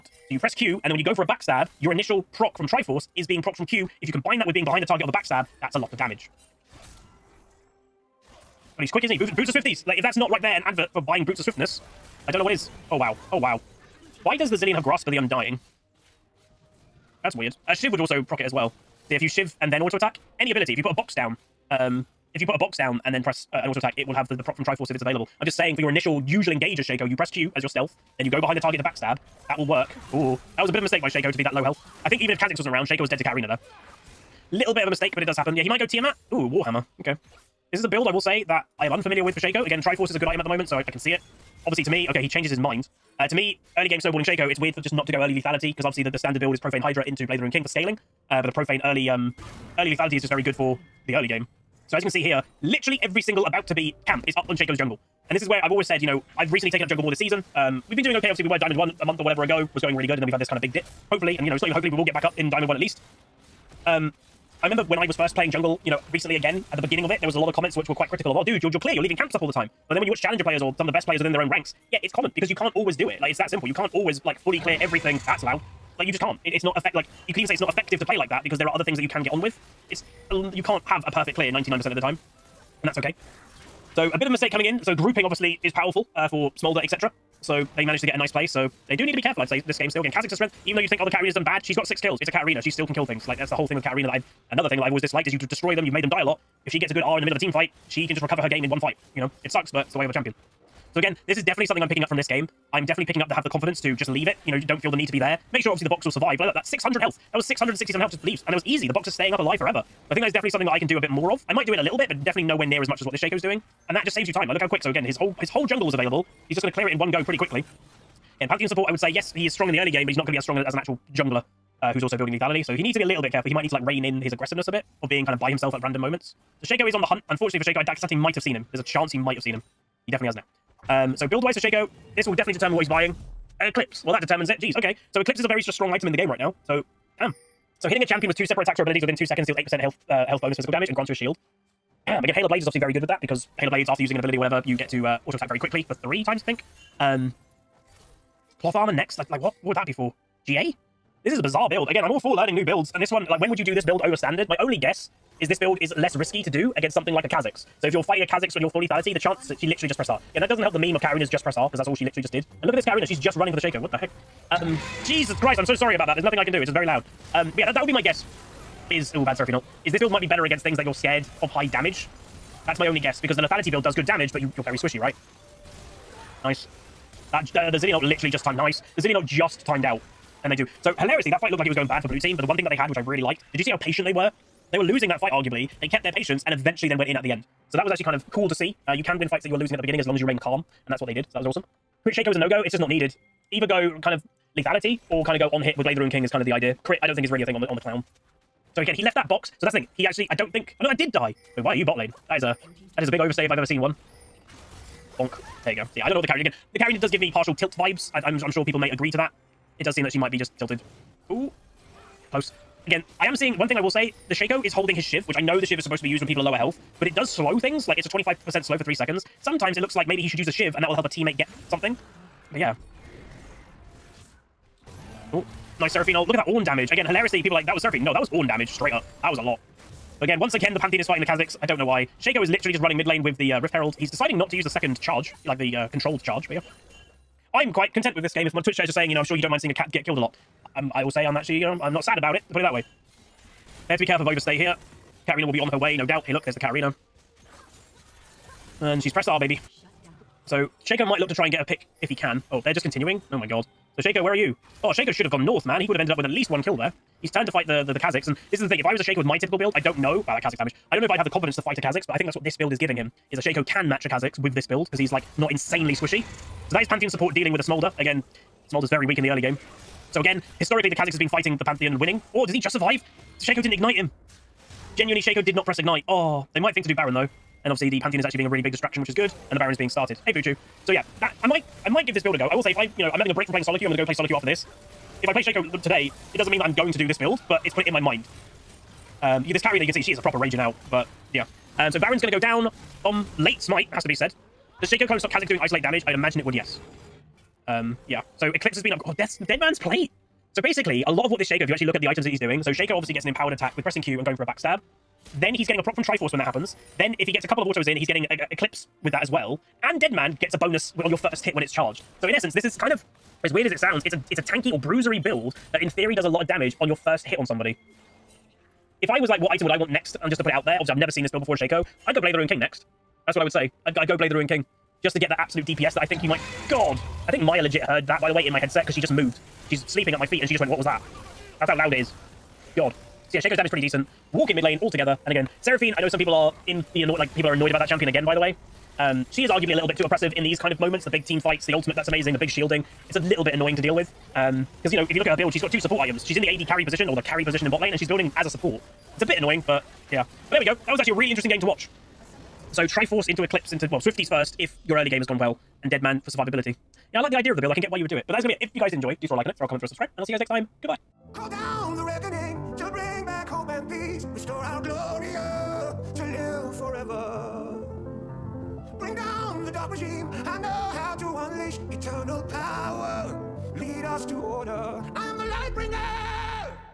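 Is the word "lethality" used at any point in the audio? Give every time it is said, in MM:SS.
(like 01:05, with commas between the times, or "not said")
00:45, 00:49, 02:02, 02:38, 02:53, 03:14.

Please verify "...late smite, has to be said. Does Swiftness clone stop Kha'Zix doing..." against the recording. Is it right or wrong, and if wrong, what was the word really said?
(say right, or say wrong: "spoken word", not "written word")
wrong: "Shaco", not "Swiftness".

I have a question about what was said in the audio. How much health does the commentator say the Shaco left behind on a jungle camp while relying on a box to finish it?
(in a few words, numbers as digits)
667.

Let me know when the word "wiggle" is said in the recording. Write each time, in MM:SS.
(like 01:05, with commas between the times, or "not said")
not said.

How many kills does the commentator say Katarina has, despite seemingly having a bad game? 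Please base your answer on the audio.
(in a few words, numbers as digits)
6.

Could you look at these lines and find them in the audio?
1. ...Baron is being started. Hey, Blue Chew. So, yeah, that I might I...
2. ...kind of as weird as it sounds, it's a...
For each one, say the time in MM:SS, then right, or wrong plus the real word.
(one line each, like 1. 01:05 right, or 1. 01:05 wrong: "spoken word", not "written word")
1. 04:39 right
2. 05:12 right.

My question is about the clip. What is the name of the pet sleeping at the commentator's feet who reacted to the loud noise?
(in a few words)
Maya.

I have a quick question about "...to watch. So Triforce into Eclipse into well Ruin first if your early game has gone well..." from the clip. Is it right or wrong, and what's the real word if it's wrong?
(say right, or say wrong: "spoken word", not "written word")
wrong: "Swifties", not "Ruin".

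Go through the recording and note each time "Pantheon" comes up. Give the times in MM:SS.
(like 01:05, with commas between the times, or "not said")
01:58, 03:50, 04:26, 04:31, 04:37.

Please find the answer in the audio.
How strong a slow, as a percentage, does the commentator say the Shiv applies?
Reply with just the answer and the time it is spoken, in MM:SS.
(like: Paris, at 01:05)
25%, at 03:38.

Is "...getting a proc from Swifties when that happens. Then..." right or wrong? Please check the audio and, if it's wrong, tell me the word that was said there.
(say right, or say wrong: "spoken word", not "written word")
wrong: "Triforce", not "Swifties".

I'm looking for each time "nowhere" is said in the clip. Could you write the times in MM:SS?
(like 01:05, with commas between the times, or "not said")
01:52.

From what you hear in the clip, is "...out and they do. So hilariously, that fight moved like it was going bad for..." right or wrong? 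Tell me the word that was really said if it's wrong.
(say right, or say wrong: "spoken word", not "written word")
wrong: "looked", not "moved".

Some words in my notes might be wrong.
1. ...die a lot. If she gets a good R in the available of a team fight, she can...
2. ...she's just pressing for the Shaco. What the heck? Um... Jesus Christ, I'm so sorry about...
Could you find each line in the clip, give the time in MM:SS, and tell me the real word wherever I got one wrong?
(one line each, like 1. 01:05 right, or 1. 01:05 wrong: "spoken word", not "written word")
1. 01:36 wrong: "middle", not "available"
2. 02:43 wrong: "running", not "pressing".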